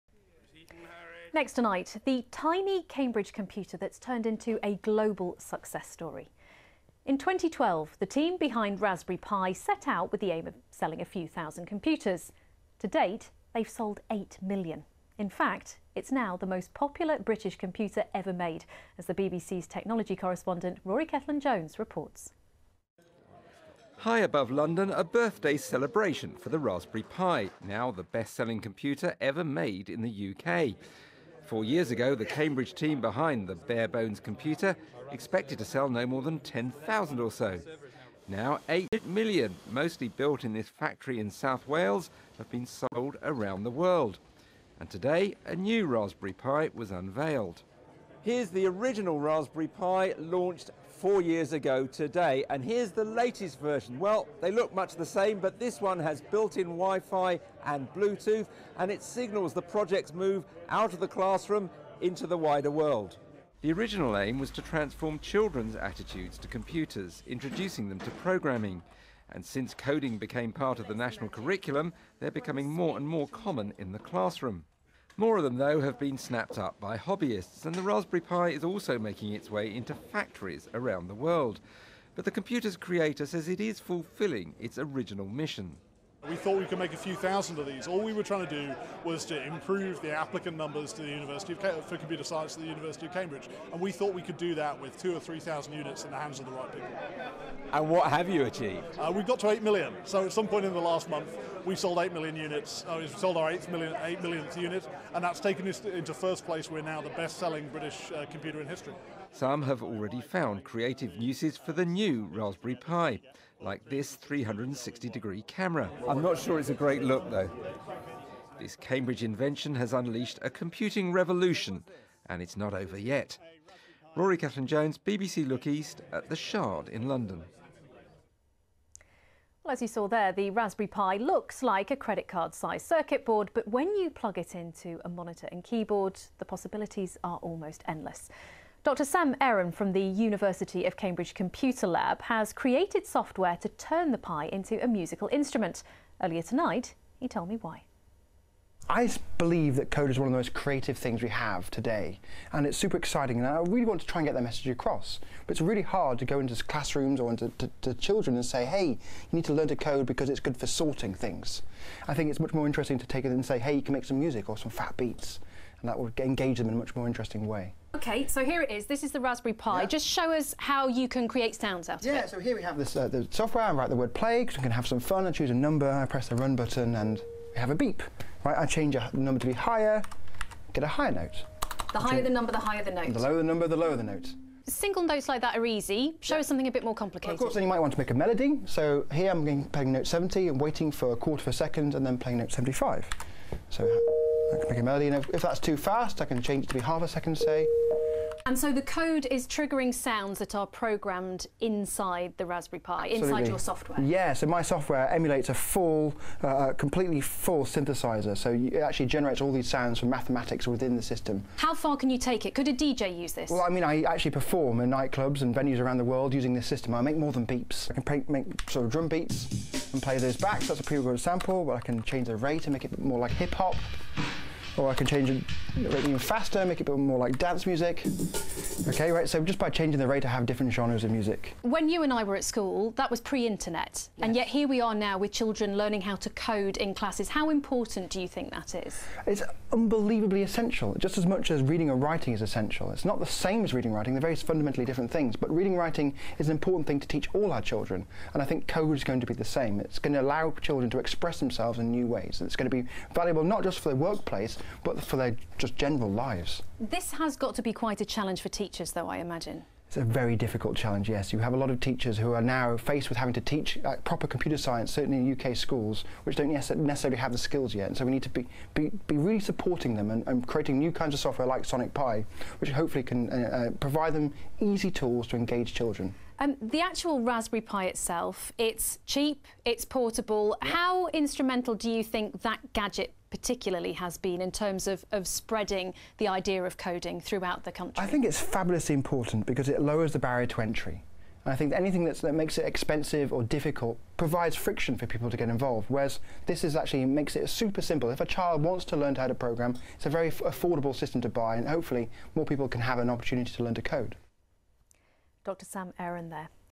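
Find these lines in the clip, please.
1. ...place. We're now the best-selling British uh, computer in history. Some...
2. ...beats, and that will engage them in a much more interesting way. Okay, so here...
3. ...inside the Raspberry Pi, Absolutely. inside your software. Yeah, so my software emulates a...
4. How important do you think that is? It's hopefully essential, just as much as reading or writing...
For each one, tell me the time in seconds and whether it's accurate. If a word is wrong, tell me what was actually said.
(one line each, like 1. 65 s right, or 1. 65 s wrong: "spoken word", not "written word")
1. 106 s right
2. 164 s right
3. 201 s right
4. 237 s wrong: "unbelievably", not "hopefully".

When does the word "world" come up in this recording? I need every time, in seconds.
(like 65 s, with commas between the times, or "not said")
43 s, 62 s, 81 s, 216 s.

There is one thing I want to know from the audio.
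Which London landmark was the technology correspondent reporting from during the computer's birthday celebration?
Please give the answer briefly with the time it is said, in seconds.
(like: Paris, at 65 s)
the Shard, at 126 s.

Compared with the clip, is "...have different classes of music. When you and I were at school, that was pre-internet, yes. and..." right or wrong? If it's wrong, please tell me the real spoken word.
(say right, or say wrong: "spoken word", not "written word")
wrong: "genres", not "classes".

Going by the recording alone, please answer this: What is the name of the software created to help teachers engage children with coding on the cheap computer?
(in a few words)
Sonic Pi.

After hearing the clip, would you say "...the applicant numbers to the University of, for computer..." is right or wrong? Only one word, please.
right.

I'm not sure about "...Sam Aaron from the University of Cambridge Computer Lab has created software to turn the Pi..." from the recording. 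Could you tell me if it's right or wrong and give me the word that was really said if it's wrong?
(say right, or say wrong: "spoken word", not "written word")
right.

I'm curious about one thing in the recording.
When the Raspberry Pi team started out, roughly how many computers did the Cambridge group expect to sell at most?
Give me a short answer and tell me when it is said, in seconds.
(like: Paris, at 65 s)
10,000, at 36 s.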